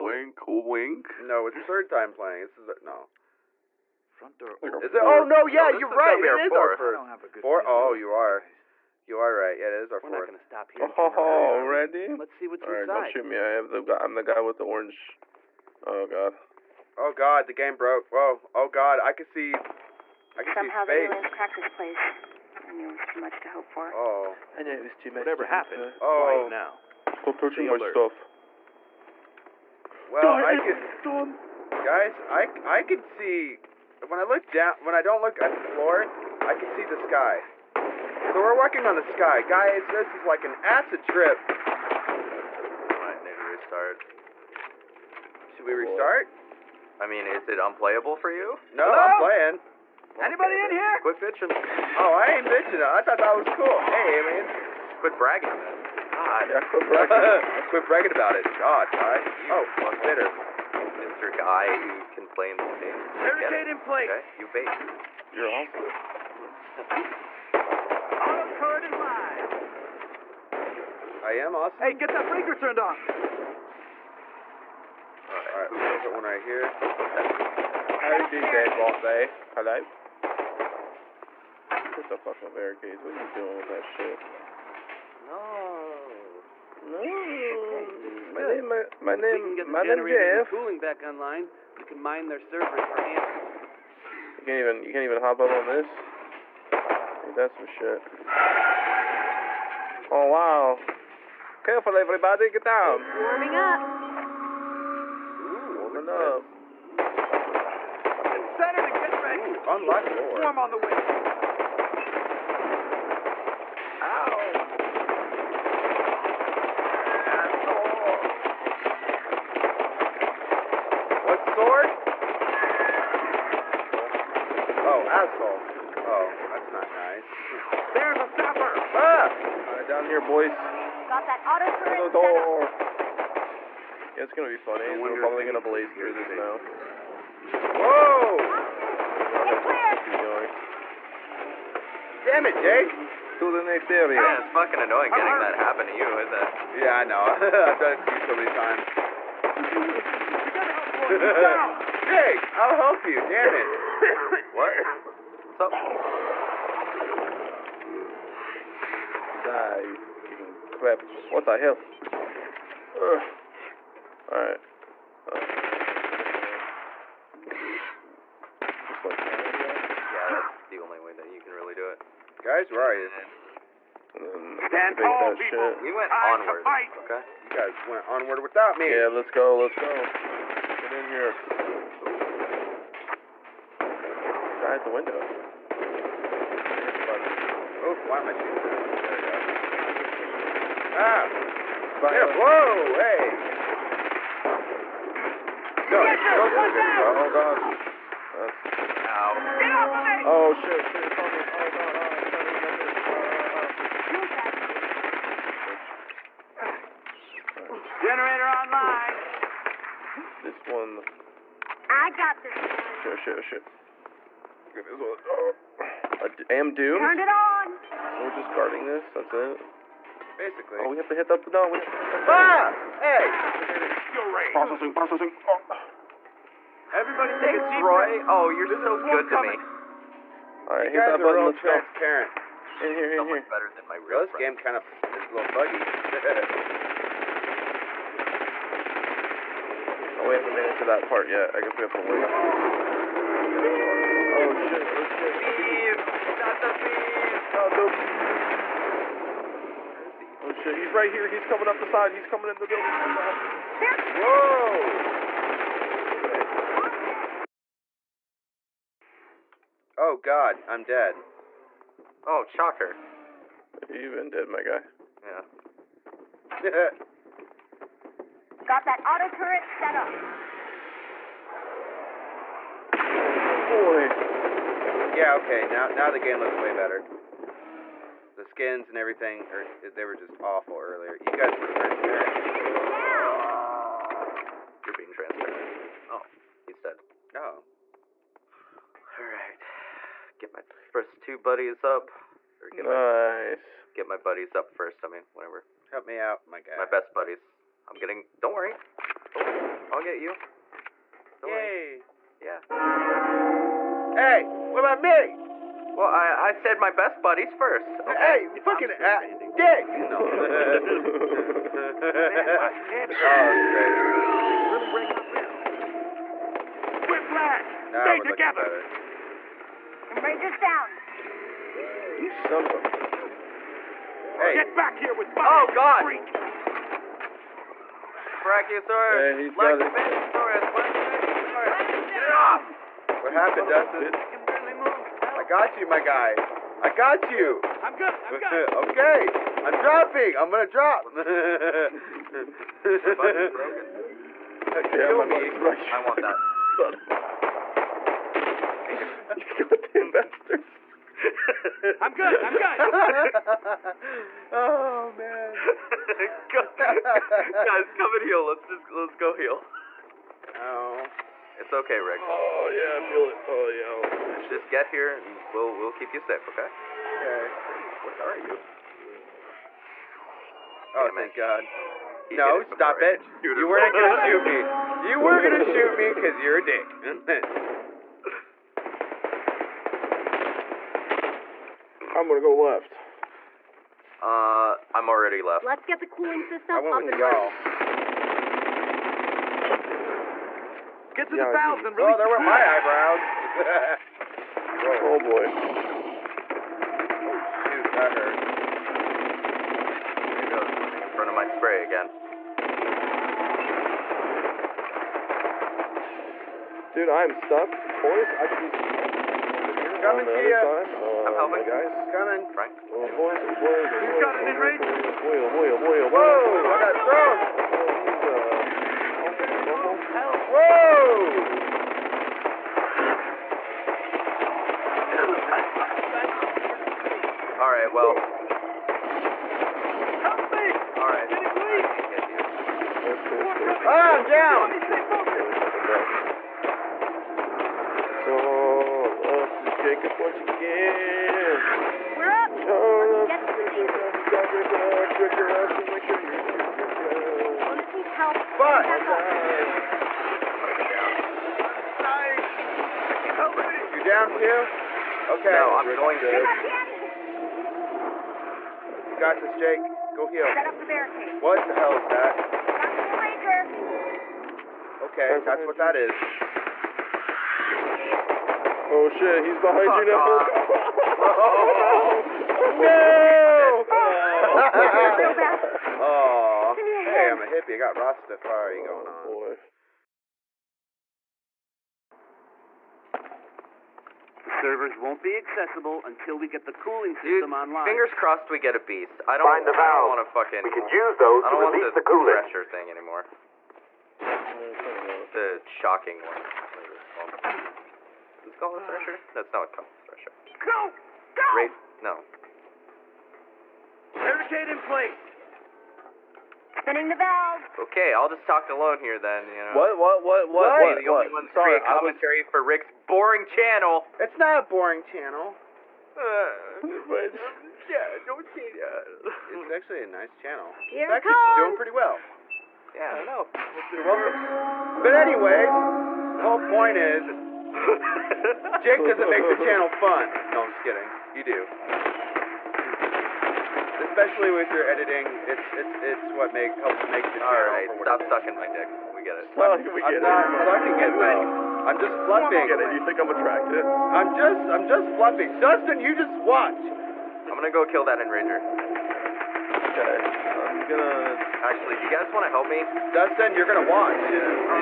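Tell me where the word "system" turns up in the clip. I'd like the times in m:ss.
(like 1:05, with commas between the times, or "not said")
6:26, 8:07.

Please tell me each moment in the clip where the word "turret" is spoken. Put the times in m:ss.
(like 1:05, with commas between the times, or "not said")
1:08, 2:11, 4:29.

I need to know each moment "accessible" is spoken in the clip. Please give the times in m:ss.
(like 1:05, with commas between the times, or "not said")
8:05.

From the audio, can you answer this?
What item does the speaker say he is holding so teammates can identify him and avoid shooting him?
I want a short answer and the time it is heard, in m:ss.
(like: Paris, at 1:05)
The orange, at 0:14.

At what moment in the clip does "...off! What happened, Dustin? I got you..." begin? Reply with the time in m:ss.
5:32.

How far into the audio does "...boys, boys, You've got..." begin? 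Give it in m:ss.
6:53.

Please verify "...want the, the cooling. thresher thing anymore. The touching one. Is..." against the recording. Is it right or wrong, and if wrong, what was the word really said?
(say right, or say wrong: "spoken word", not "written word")
wrong: "shocking", not "touching".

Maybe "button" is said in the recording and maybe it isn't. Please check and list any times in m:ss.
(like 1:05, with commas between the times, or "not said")
3:51, 5:42.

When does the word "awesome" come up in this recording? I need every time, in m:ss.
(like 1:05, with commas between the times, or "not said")
1:05, 1:11.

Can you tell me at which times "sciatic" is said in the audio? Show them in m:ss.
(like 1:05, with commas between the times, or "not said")
not said.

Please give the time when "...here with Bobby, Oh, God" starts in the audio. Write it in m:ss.
5:24.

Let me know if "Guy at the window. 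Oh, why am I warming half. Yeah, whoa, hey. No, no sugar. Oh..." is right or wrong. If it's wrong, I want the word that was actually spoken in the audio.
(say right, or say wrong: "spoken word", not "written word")
wrong: "shooting", not "warming".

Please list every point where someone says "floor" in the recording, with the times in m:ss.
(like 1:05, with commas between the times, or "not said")
0:35.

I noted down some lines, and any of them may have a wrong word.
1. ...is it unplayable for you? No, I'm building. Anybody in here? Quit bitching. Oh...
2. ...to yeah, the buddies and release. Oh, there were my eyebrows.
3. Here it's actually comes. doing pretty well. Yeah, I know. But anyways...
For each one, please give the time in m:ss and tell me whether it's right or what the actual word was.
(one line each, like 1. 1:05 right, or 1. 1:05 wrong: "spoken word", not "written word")
1. 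0:47 wrong: "playing", not "building"
2. 6:31 wrong: "valves", not "buddies"
3. 8:40 right.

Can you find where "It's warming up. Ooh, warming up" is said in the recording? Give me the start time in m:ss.
1:43.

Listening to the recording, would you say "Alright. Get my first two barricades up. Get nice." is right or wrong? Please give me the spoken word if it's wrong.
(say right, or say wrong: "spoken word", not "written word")
wrong: "buddies", not "barricades".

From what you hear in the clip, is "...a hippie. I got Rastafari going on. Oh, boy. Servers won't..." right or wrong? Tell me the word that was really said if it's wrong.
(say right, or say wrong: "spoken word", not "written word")
right.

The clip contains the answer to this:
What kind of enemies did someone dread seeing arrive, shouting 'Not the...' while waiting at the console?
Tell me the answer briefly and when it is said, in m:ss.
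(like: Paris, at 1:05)
The thieves, at 4:05.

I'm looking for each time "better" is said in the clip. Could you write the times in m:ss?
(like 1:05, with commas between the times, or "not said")
3:53, 4:36.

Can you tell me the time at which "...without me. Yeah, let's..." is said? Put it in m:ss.
2:58.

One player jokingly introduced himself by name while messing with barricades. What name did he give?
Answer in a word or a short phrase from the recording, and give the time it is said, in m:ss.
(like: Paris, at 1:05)
Jeff, at 1:30.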